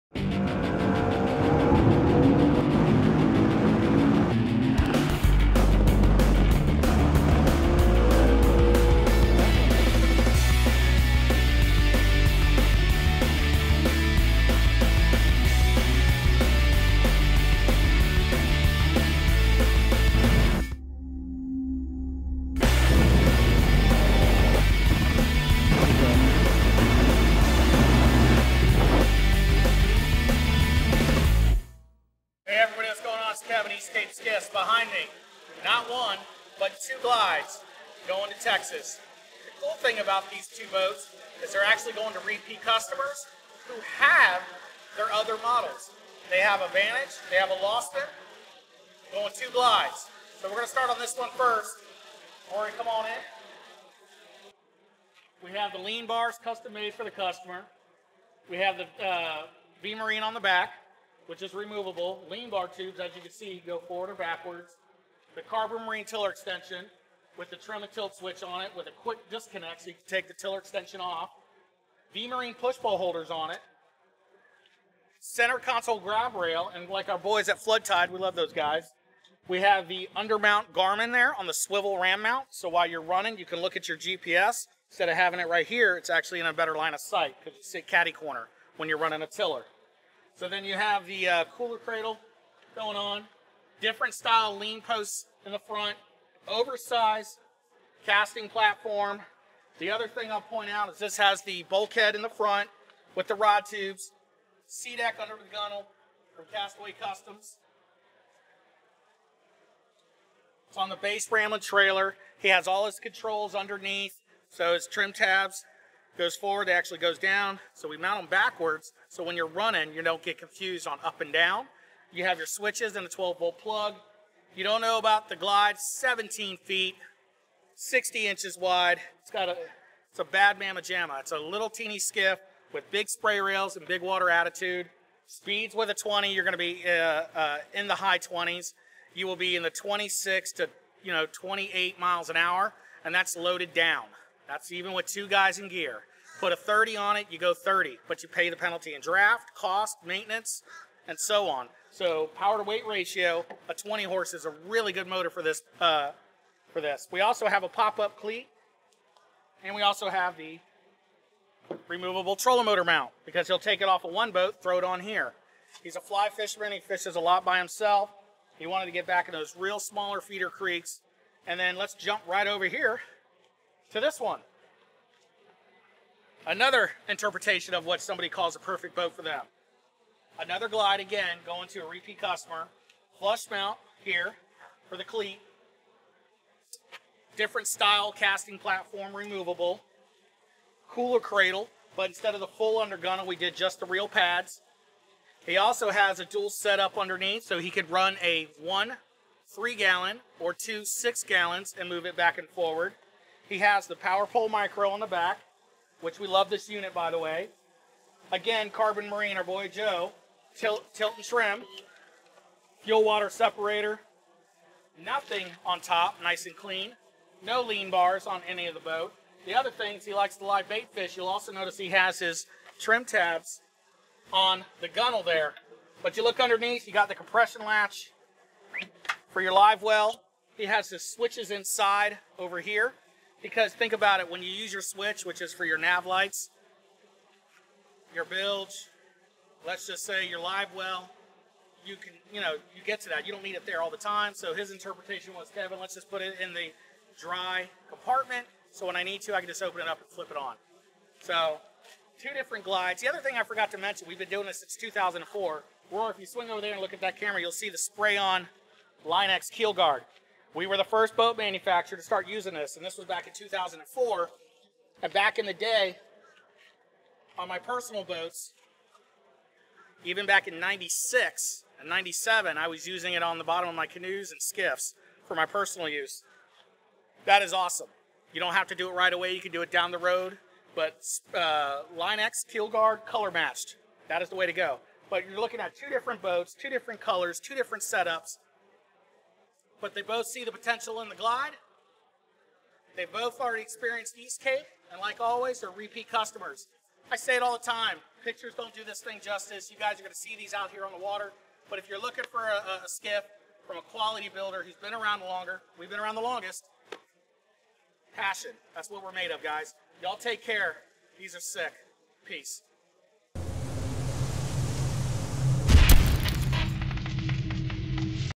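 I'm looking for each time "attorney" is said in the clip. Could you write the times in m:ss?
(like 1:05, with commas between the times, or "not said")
not said.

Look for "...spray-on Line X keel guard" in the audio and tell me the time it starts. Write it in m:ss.
4:17.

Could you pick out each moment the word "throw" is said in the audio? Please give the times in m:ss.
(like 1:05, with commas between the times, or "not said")
2:44.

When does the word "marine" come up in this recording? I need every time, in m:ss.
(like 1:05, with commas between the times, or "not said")
0:59, 1:05, 1:12, 3:29.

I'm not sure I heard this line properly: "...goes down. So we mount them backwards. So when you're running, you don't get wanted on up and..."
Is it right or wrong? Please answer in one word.
wrong.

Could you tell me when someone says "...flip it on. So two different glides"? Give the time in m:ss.
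4:10.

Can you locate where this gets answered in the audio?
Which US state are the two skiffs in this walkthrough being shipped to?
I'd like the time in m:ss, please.
0:38.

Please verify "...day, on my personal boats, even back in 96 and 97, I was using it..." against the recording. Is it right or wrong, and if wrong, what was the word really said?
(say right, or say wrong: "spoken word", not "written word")
right.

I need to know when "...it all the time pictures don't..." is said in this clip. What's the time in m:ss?
4:57.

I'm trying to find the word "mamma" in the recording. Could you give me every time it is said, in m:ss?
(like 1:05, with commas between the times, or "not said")
2:10.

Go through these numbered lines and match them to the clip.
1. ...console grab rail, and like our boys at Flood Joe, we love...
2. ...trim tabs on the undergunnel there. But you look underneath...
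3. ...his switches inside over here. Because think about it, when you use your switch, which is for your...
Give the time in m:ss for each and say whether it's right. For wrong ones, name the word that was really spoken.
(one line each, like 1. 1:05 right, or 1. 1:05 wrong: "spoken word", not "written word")
1. 1:15 wrong: "Tide", not "Joe"
2. 3:42 wrong: "gunnel", not "undergunnel"
3. 3:50 right.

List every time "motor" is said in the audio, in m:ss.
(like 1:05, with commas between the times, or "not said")
2:35, 2:42.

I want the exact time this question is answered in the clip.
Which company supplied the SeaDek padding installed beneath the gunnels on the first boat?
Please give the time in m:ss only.
1:46.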